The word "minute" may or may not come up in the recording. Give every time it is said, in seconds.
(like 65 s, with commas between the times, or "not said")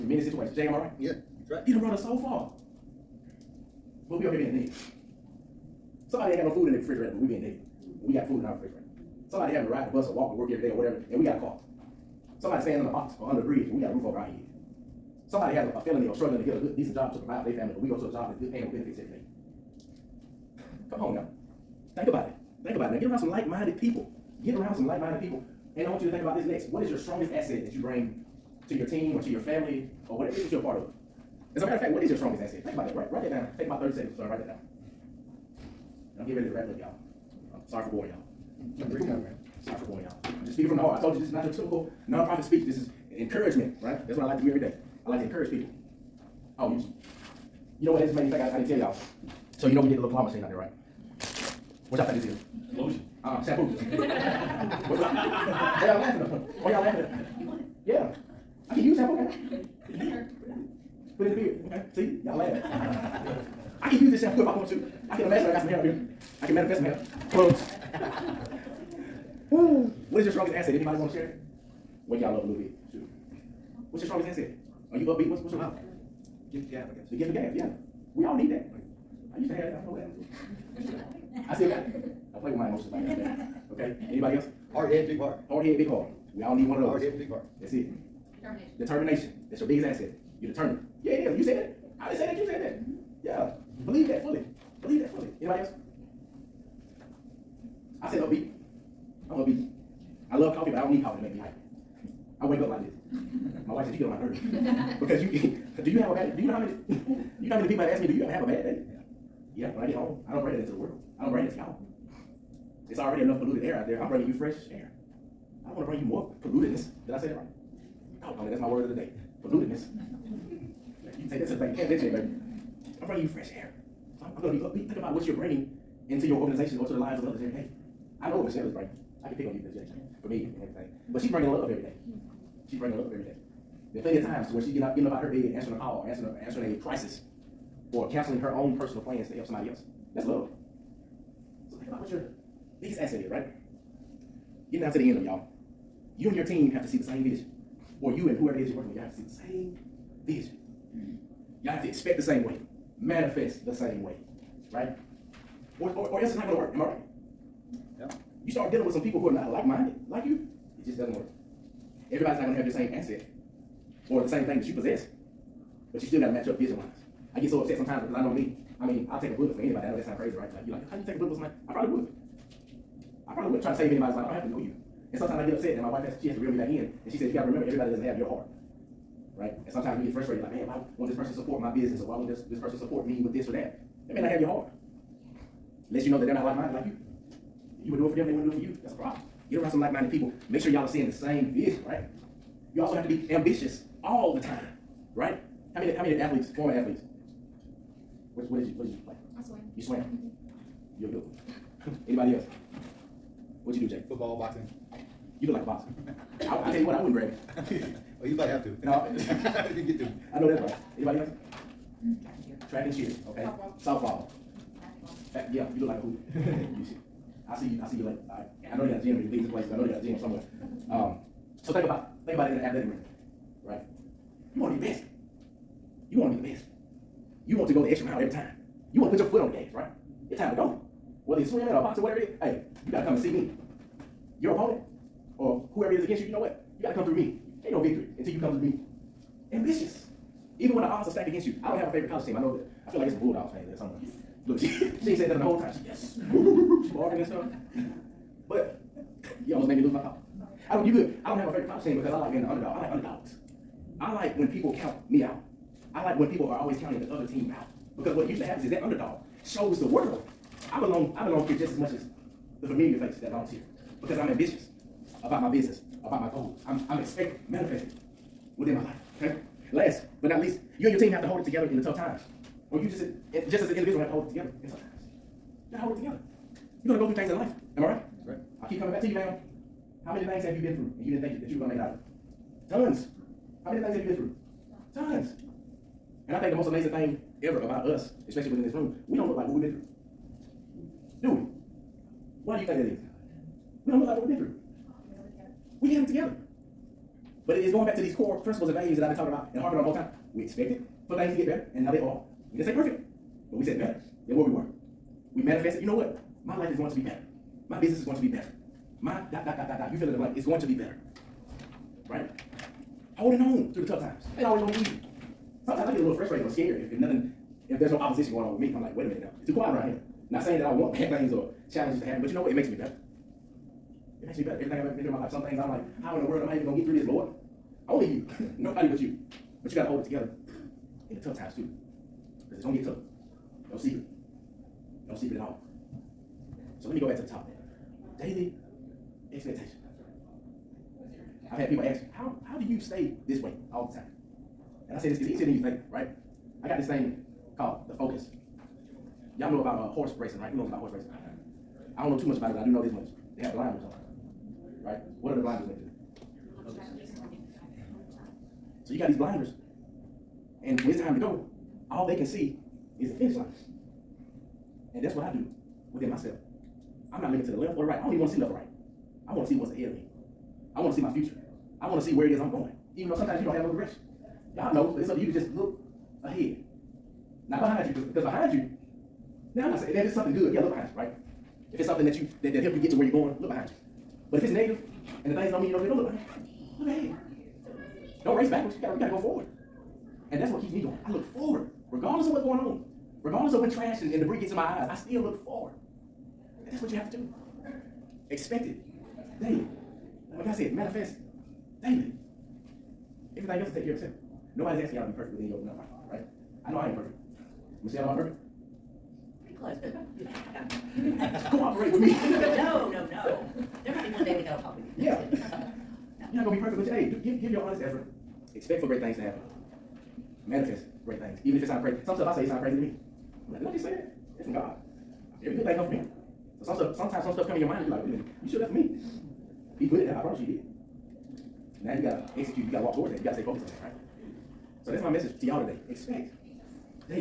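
319 s, 428 s.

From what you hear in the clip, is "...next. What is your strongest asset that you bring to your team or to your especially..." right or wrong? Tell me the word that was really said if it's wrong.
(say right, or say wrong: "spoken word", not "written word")
wrong: "family", not "especially".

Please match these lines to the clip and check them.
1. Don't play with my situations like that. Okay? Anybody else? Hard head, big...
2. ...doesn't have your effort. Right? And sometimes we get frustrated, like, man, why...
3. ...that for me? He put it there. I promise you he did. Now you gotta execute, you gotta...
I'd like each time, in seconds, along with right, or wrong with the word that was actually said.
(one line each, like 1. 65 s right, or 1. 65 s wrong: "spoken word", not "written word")
1. 82 s wrong: "emotions", not "situations"
2. 177 s wrong: "heart", not "effort"
3. 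428 s right.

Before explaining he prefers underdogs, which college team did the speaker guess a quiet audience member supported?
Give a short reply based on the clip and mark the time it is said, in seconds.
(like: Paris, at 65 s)
Bulldogs, at 243 s.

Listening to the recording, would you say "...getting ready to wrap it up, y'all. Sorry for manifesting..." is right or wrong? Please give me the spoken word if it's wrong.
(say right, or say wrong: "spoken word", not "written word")
wrong: "boring", not "manifesting".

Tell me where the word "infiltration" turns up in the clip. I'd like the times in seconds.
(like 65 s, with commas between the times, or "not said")
not said.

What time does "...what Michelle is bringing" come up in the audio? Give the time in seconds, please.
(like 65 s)
128 s.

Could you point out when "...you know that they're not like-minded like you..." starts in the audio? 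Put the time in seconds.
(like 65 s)
186 s.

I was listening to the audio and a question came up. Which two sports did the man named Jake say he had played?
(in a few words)
Football, boxing.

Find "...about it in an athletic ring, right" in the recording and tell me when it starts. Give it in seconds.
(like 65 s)
222 s.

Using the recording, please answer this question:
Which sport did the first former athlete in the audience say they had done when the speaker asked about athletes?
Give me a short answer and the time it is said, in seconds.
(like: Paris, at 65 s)
Swimming, at 199 s.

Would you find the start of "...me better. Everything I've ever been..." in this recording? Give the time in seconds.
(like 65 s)
324 s.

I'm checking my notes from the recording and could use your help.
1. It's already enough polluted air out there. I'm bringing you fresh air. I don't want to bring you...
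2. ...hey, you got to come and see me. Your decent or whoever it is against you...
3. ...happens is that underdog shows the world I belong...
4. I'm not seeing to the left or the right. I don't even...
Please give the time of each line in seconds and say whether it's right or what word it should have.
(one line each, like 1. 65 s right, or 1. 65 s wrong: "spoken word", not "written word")
1. 112 s right
2. 232 s wrong: "opponent", not "decent"
3. 258 s right
4. 367 s wrong: "looking", not "seeing".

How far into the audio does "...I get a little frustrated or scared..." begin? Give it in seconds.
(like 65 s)
315 s.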